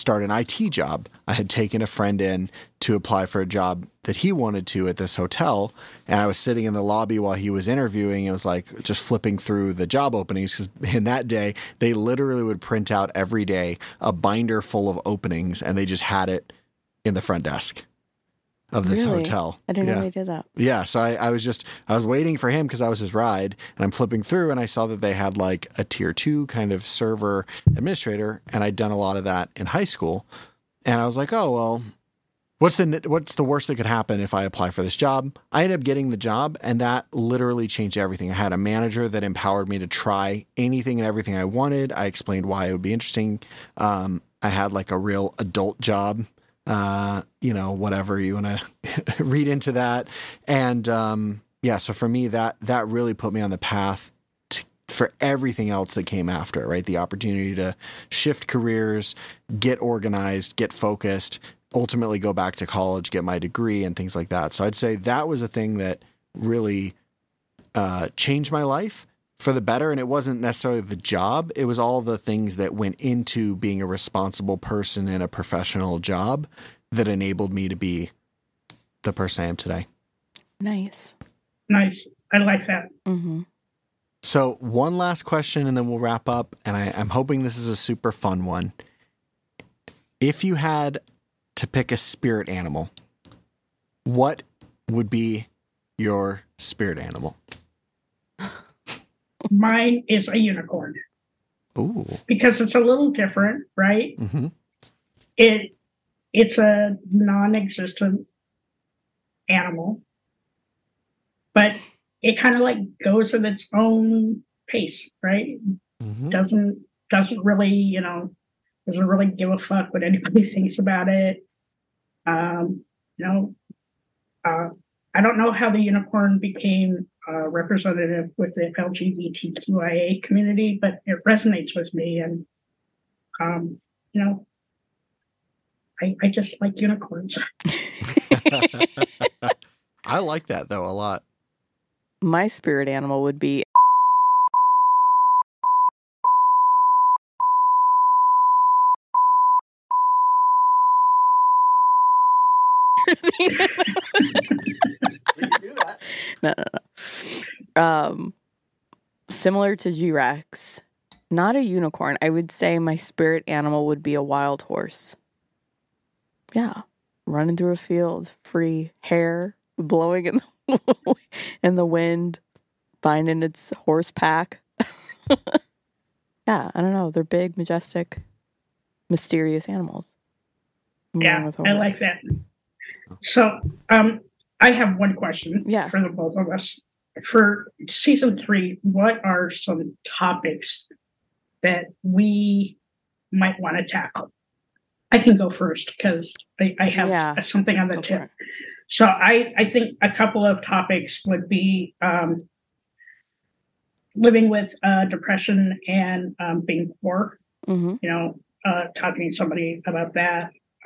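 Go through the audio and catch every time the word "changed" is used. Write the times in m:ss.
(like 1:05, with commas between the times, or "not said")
0:37, 1:08.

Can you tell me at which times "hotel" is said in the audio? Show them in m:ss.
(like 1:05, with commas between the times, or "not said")
0:05, 0:19.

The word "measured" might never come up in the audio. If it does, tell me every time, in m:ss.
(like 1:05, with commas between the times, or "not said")
not said.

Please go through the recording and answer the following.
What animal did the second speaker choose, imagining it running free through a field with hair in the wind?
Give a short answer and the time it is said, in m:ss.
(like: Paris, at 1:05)
Wild horse, at 2:44.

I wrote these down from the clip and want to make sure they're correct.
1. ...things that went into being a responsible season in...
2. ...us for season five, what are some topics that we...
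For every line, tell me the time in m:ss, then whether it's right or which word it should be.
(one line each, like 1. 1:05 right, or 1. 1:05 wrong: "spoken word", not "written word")
1. 1:12 wrong: "person", not "season"
2. 3:06 wrong: "three", not "five".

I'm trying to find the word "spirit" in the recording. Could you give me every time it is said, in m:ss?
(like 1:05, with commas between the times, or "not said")
1:31, 1:36, 2:22, 2:42.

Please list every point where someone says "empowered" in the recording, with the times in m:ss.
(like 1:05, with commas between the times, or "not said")
0:39.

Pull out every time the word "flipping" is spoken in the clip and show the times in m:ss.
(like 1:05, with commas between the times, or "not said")
0:09, 0:23.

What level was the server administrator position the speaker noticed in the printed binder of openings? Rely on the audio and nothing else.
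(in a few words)
Tier two.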